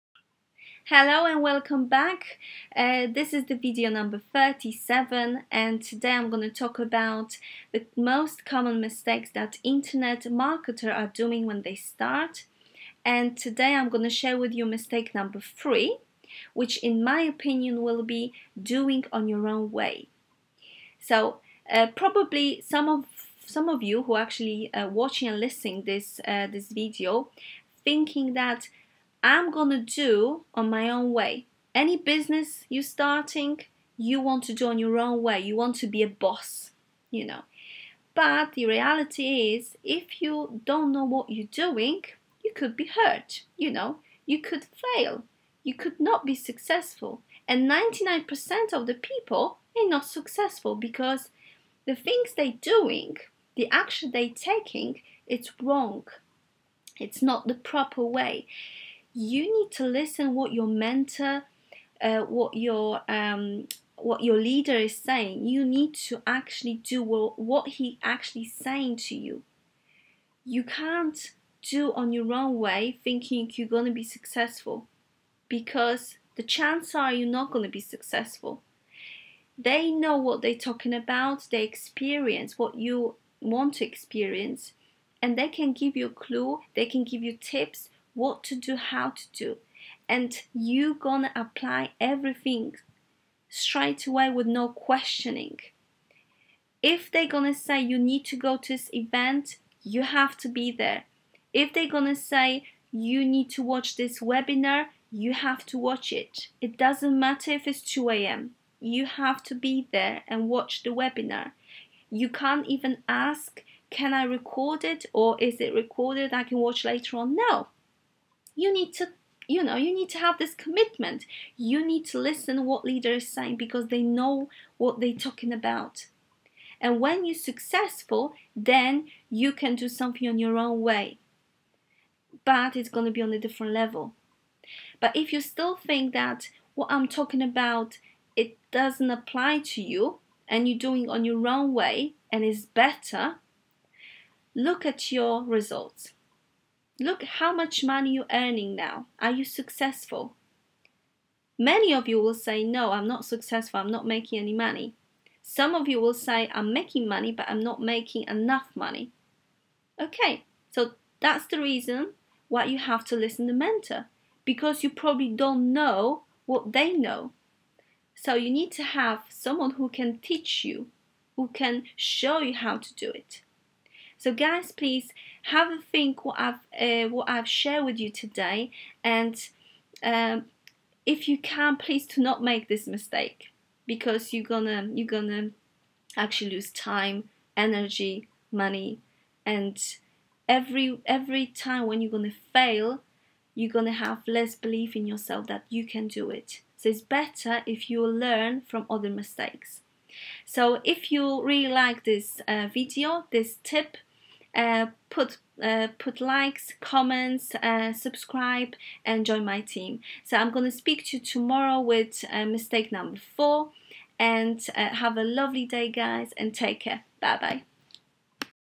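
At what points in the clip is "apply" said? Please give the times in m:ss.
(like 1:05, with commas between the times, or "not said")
1:31, 2:19.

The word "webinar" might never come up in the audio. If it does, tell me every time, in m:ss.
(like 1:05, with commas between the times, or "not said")
1:44, 1:50.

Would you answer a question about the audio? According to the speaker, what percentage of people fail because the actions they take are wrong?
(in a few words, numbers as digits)
99%.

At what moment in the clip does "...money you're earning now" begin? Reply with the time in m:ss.
2:27.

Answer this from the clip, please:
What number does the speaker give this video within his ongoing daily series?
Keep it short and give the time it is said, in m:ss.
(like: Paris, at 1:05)
37, at 0:04.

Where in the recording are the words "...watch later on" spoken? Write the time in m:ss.
1:56.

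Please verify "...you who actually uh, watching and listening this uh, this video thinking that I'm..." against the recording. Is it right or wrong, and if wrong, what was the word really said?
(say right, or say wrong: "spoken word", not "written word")
right.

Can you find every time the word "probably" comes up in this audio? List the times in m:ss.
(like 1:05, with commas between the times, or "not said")
0:21, 2:44.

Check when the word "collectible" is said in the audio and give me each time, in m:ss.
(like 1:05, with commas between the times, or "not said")
not said.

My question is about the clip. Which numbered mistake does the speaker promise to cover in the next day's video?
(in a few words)
Mistake number 4.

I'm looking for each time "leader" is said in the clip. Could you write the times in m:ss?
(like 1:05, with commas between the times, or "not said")
1:04, 2:02.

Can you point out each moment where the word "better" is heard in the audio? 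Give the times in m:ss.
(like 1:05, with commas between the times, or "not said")
2:22, 3:17.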